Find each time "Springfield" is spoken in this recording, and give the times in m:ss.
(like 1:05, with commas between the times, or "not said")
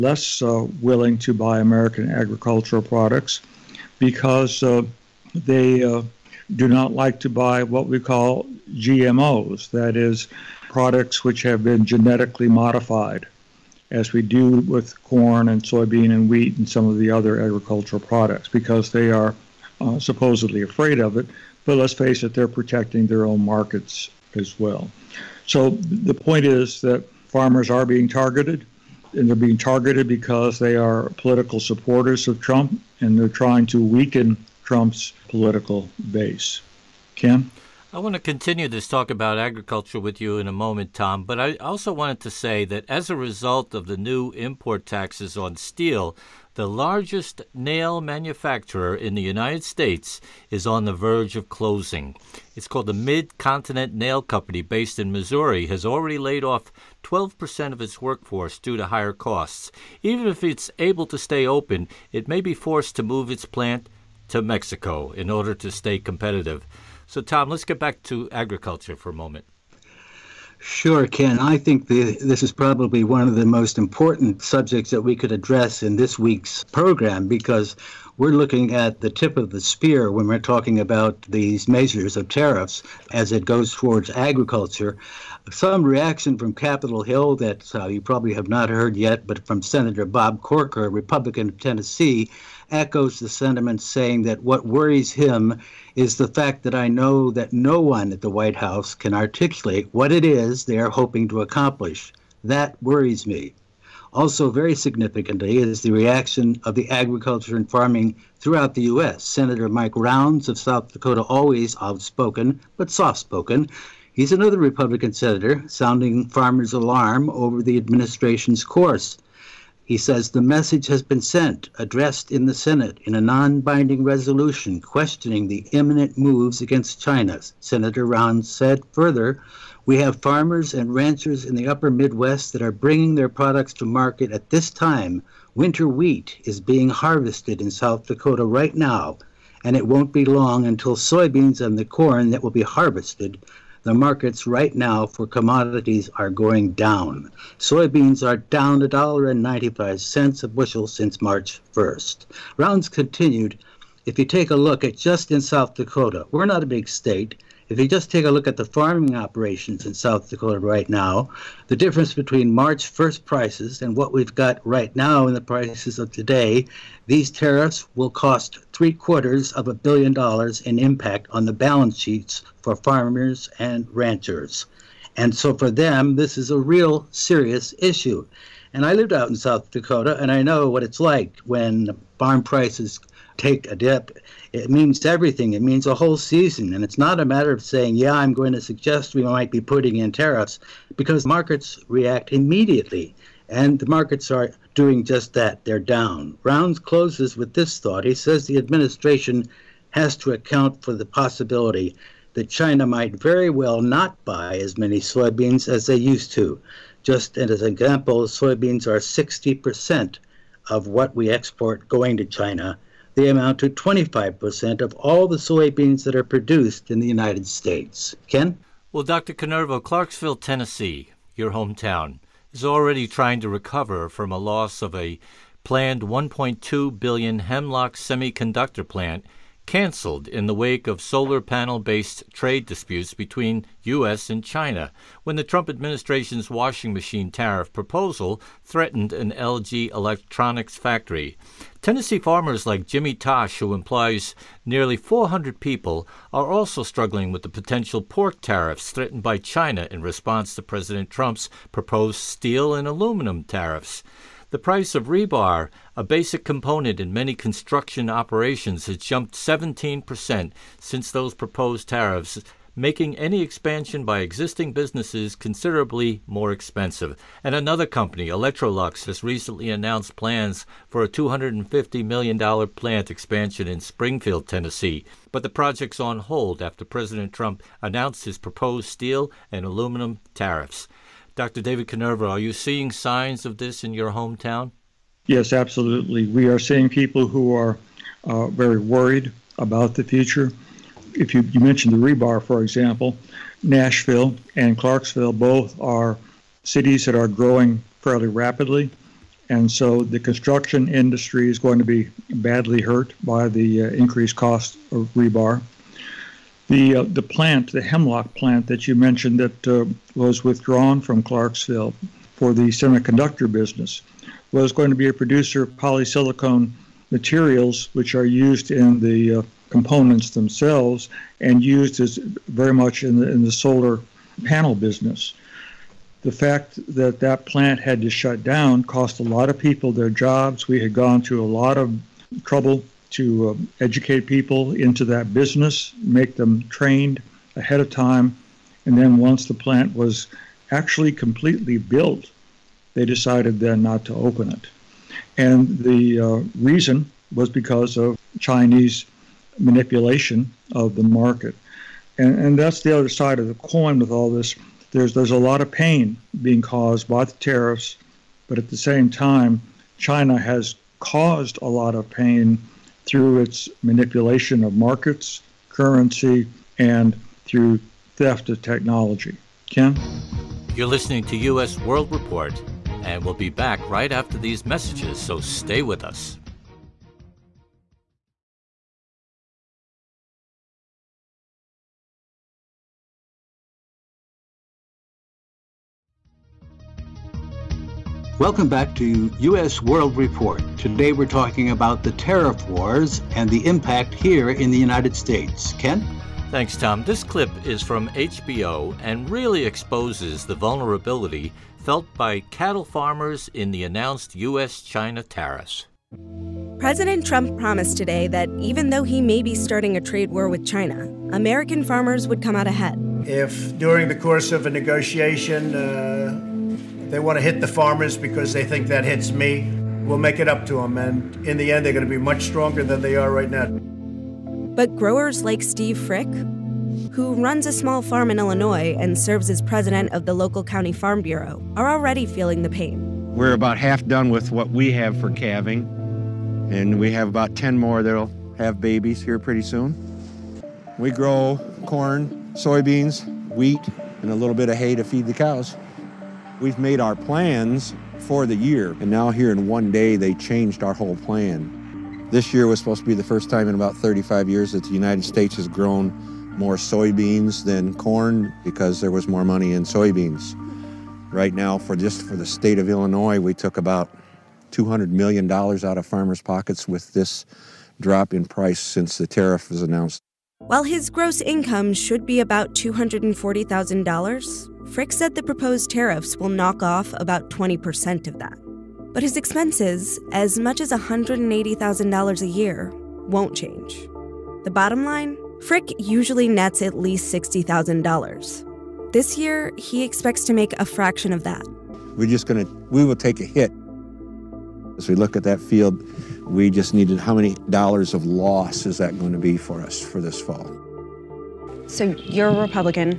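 4:33.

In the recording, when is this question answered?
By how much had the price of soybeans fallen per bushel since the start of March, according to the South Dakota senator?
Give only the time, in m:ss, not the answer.
2:28.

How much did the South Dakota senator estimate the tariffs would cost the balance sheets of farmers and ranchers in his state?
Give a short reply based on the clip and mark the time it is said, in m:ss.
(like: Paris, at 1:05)
three quarters of a billion dollars, at 2:48.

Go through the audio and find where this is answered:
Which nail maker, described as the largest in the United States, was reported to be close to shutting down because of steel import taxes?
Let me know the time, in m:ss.
0:52.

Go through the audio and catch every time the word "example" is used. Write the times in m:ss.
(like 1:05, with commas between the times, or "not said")
3:27, 4:52.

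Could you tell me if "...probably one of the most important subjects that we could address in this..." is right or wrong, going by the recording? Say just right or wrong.
right.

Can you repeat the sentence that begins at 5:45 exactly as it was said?
And the uh, reason was because of Chinese manipulation of the market.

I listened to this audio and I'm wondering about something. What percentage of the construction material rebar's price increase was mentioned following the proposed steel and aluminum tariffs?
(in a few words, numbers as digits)
17%.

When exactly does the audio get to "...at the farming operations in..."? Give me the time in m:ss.
2:38.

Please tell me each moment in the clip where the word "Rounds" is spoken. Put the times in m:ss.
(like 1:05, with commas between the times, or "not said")
1:49, 2:32, 3:16.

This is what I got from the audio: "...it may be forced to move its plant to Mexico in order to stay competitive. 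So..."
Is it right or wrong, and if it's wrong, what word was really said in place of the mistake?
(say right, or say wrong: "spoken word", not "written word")
right.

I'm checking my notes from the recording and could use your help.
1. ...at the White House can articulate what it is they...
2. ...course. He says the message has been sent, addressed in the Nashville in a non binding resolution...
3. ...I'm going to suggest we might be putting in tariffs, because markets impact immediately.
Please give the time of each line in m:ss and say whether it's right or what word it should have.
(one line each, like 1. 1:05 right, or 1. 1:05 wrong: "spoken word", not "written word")
1. 1:38 right
2. 1:58 wrong: "Senate", not "Nashville"
3. 3:08 wrong: "react", not "impact".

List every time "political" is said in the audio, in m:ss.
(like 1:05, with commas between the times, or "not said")
0:31, 0:35.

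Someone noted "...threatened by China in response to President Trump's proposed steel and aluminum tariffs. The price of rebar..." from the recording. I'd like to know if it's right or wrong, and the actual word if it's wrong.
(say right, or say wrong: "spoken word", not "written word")
right.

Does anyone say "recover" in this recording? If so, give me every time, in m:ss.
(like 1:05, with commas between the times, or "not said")
3:43.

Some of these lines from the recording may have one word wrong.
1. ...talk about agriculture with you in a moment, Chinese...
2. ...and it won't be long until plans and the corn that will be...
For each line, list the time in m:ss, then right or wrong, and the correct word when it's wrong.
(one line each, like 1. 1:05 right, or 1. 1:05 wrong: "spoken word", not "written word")
1. 0:38 wrong: "Tom", not "Chinese"
2. 2:19 wrong: "soybeans", not "plans".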